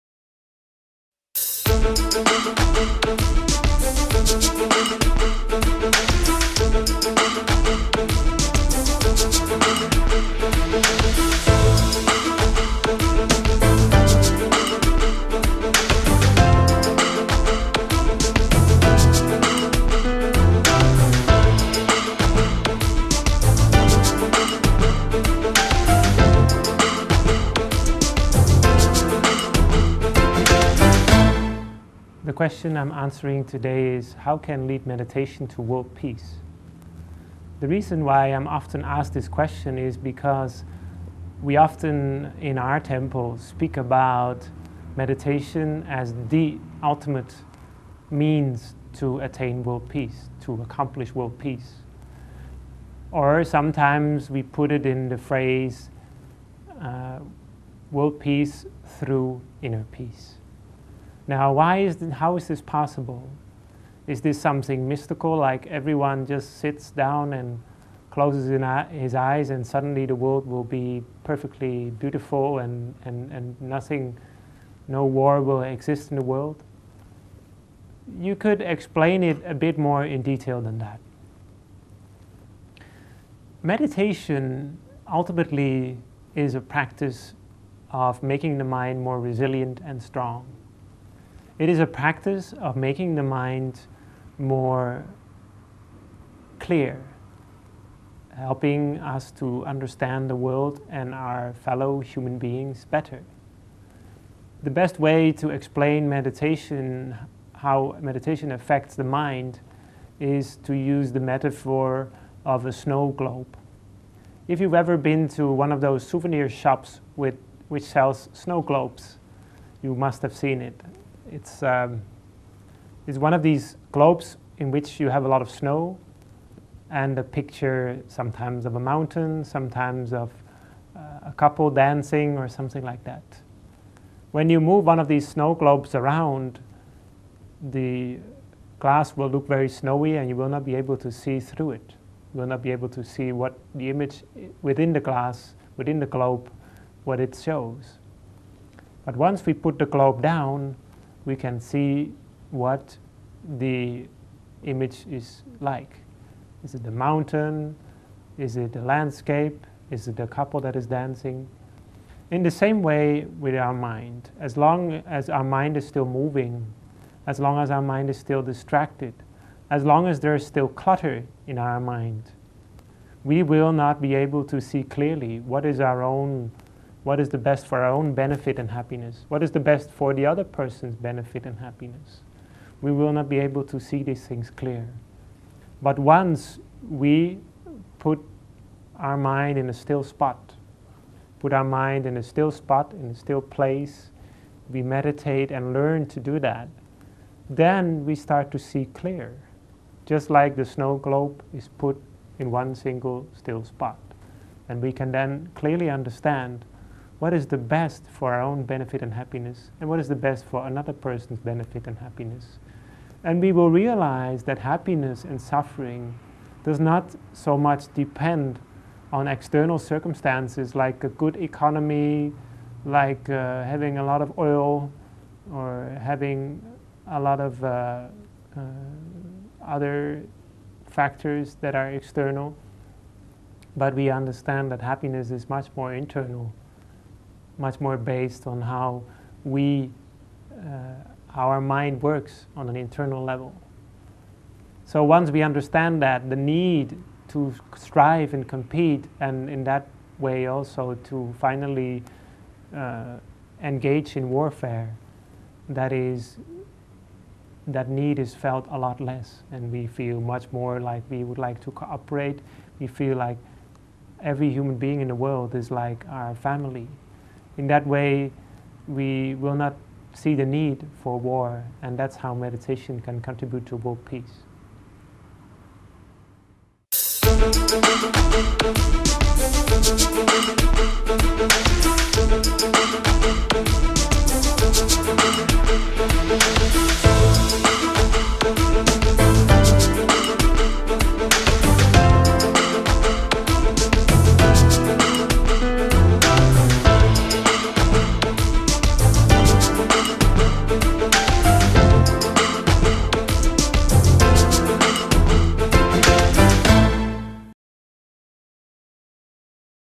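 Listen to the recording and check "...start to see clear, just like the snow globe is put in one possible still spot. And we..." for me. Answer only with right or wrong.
wrong.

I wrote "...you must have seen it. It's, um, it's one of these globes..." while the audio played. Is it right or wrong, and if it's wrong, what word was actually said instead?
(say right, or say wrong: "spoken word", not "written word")
right.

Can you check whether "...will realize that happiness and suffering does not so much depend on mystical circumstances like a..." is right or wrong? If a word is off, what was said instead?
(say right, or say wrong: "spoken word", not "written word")
wrong: "external", not "mystical".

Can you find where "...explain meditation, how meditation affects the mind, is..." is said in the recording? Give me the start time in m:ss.
1:45.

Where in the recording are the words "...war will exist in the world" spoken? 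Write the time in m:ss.
1:15.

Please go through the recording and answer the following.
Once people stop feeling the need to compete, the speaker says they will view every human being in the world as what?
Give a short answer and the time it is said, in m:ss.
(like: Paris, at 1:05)
Family, at 4:26.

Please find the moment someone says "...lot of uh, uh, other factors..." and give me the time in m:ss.
3:47.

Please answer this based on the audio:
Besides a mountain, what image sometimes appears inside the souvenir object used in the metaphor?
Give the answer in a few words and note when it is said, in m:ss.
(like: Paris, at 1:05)
A couple dancing, at 2:11.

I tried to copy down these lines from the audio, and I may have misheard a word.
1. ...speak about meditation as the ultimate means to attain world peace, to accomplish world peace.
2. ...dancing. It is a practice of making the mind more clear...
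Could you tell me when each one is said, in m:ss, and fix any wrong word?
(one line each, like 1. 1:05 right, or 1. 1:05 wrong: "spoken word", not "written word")
1. 0:43 right
2. 1:30 wrong: "strong", not "dancing".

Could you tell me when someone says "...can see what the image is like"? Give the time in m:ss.
2:31.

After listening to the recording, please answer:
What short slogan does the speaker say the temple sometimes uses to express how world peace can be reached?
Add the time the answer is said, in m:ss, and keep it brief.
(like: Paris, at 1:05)
World peace through inner peace, at 0:57.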